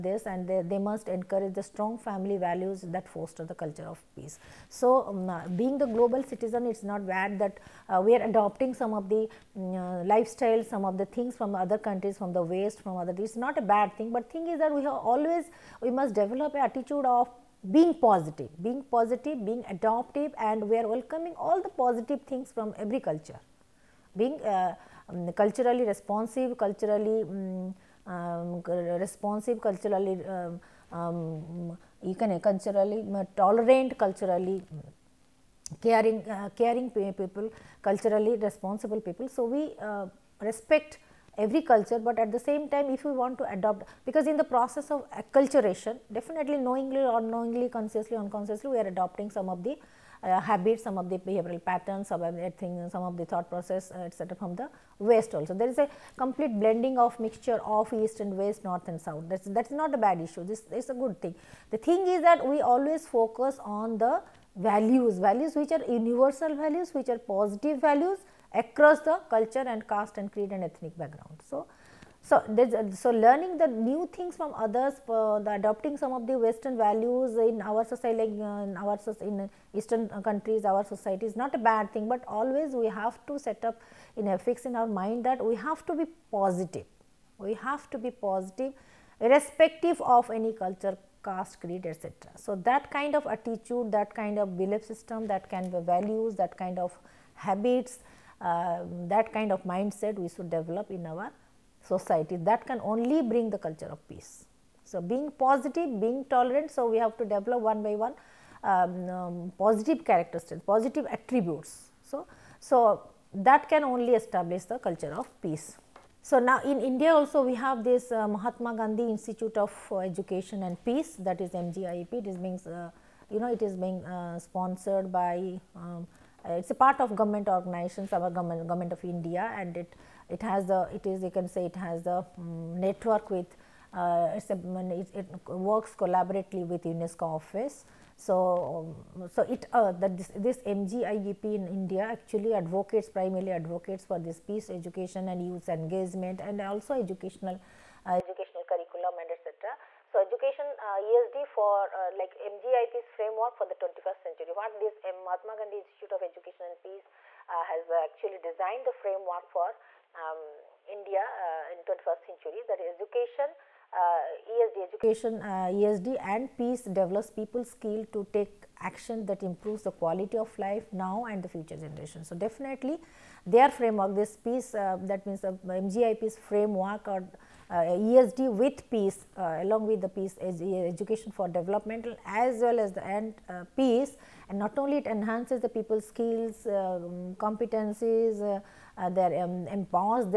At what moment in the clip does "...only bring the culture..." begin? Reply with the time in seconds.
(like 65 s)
102 s.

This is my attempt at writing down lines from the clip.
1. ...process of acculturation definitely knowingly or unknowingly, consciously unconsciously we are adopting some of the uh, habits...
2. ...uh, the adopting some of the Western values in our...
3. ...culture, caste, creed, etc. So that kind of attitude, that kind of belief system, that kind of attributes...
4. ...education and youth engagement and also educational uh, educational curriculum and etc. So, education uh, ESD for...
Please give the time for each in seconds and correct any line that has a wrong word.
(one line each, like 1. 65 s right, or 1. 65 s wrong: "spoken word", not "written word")
1. 44 s right
2. 75 s right
3. 90 s wrong: "values", not "attributes"
4. 144 s right.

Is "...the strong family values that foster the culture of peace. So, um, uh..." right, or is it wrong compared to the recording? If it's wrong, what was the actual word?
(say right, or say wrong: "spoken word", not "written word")
right.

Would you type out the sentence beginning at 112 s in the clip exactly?
So, so that can only establish the culture of peace.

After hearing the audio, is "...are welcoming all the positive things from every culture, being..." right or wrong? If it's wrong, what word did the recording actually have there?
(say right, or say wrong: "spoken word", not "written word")
right.